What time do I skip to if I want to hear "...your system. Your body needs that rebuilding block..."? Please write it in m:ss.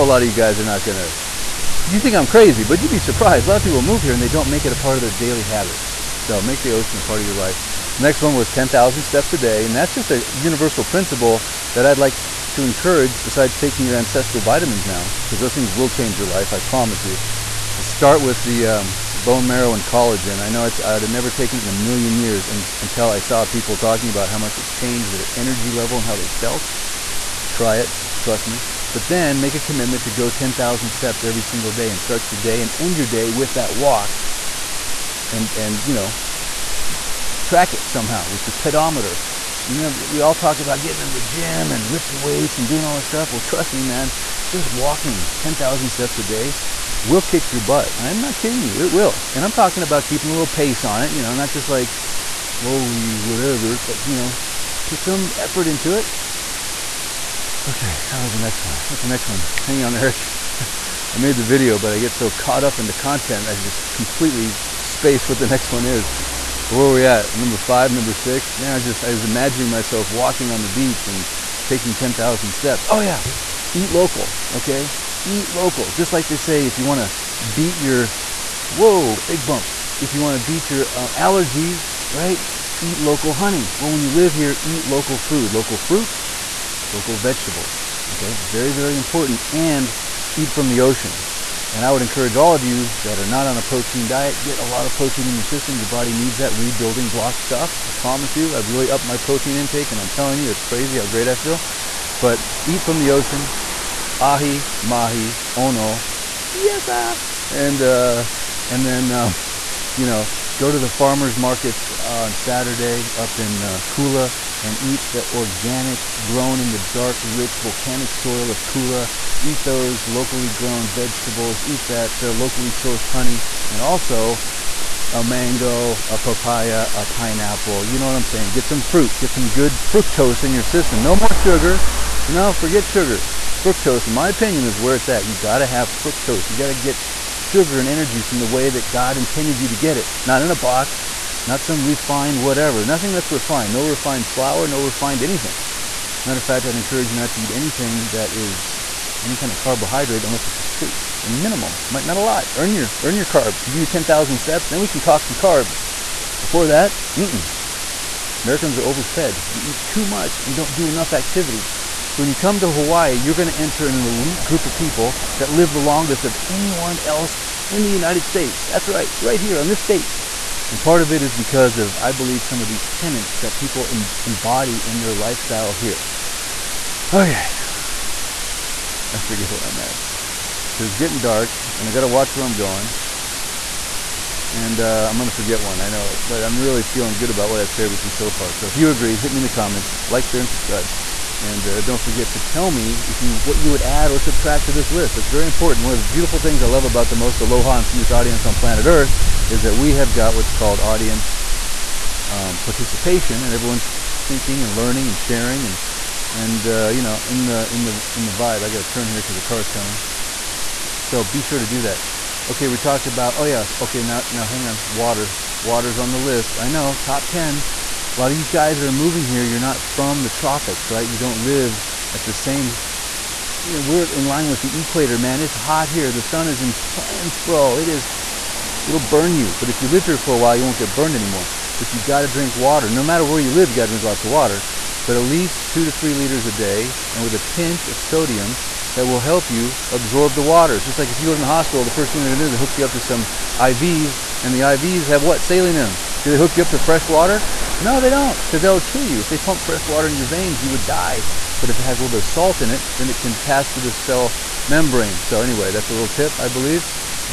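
1:35.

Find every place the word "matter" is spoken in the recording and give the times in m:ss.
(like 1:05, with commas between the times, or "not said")
2:26, 3:53.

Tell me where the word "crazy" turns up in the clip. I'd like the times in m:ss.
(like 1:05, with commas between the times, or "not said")
0:02, 1:40.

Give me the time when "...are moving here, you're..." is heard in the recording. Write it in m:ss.
3:38.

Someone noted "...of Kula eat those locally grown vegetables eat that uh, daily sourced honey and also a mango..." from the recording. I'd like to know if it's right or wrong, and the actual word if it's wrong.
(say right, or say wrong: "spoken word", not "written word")
wrong: "locally", not "daily".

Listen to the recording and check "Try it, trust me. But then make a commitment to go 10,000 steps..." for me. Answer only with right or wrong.
right.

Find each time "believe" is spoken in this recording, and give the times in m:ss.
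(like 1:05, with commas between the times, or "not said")
2:52, 4:16.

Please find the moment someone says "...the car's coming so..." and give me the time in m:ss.
3:29.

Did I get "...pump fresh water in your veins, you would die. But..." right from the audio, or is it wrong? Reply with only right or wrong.
right.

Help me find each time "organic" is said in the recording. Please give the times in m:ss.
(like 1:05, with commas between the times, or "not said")
1:55.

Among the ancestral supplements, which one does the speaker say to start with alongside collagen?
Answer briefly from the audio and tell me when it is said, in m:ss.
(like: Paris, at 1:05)
Bone marrow, at 0:19.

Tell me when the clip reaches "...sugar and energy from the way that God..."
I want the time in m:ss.
2:17.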